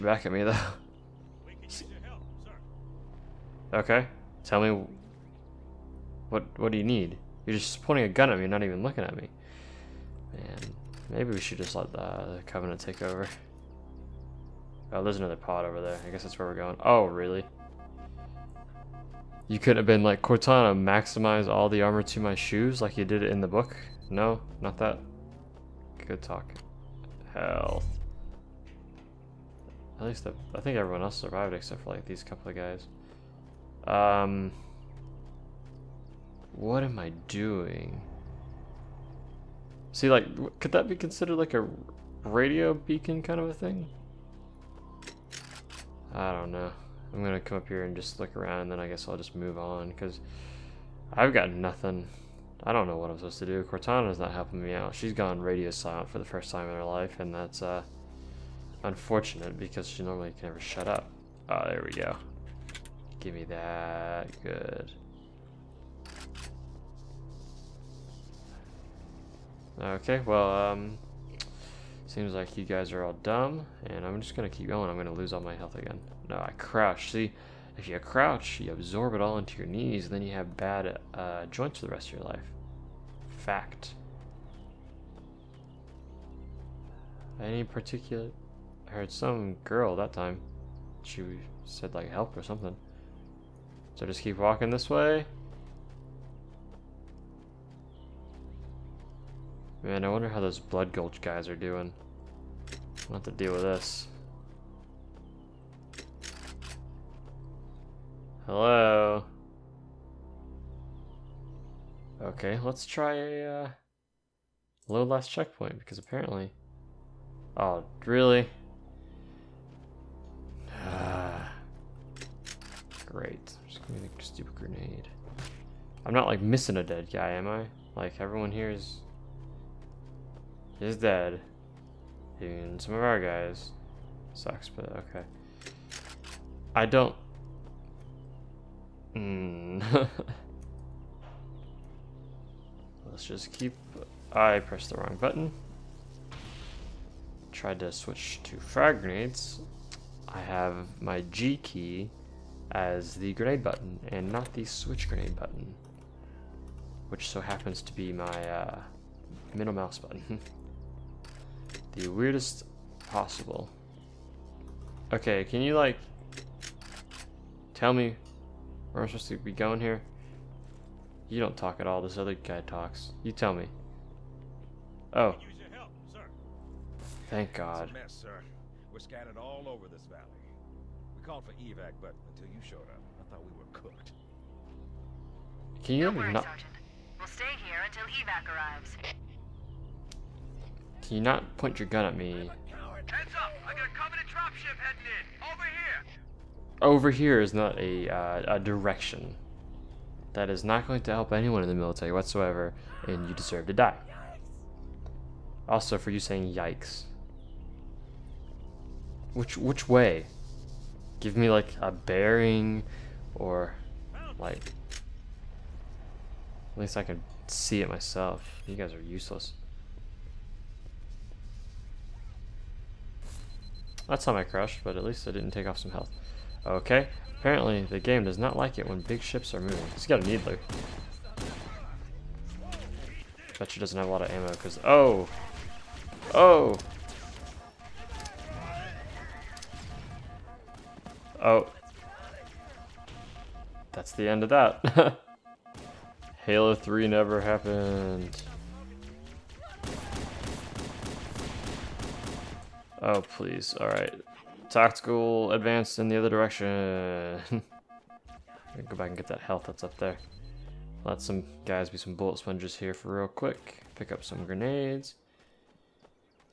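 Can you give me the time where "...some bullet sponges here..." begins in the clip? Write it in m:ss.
4:21.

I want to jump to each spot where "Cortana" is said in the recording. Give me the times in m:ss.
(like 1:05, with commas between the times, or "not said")
0:20, 0:53.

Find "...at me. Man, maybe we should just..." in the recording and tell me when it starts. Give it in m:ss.
0:09.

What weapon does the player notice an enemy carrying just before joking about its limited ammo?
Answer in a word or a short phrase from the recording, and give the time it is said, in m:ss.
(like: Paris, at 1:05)
needler, at 3:50.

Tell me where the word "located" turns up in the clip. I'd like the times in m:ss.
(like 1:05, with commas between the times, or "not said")
not said.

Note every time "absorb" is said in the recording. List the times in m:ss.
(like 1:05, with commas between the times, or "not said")
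1:18.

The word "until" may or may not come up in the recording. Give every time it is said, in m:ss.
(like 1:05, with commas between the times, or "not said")
3:02, 3:07.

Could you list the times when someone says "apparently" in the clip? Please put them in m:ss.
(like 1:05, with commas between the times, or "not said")
1:55, 3:47.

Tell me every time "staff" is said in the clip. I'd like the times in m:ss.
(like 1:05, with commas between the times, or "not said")
not said.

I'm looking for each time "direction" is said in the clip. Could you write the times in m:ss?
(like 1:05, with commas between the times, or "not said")
3:18, 4:16.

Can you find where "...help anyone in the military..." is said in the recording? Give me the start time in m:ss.
3:21.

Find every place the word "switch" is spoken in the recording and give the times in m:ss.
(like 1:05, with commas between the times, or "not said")
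2:27, 2:34.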